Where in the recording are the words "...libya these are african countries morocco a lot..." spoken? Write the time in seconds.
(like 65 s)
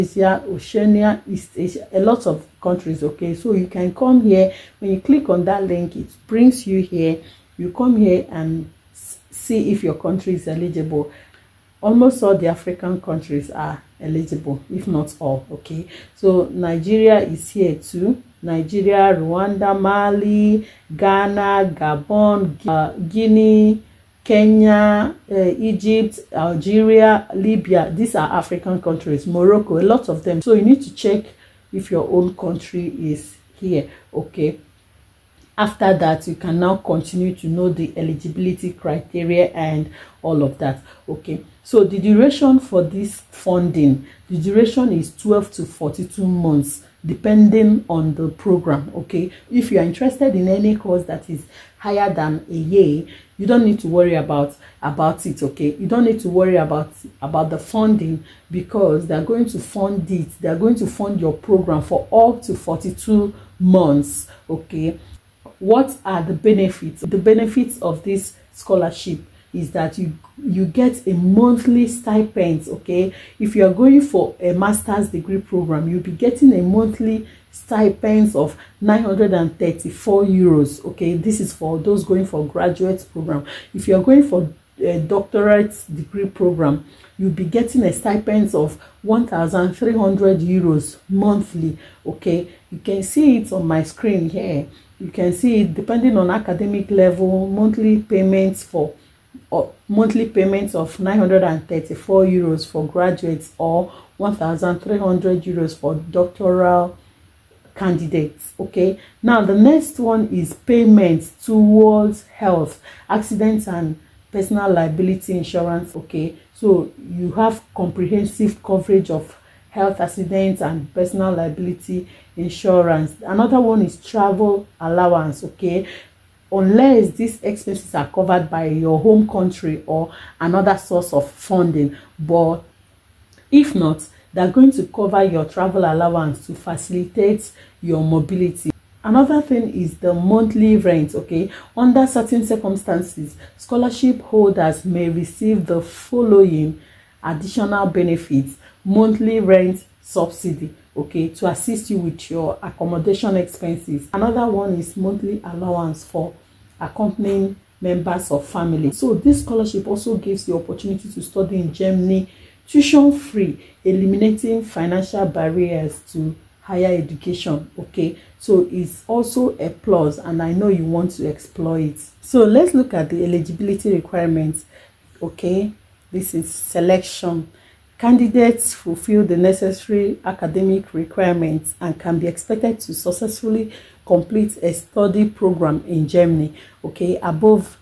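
27 s.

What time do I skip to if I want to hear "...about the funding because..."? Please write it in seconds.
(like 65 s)
57 s.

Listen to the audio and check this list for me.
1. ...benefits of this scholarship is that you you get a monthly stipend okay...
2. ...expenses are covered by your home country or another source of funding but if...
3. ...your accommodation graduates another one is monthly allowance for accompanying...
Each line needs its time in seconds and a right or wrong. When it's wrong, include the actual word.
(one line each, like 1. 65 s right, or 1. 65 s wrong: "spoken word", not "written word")
1. 67 s right
2. 127 s right
3. 152 s wrong: "expenses", not "graduates".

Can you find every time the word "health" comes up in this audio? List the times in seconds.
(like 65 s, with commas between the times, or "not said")
112 s, 119 s.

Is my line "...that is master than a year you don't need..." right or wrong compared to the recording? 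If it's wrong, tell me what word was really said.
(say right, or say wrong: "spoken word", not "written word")
wrong: "higher", not "master".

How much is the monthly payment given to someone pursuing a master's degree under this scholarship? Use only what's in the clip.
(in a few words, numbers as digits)
934 euros.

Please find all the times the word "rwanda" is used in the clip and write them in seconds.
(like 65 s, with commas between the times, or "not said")
19 s.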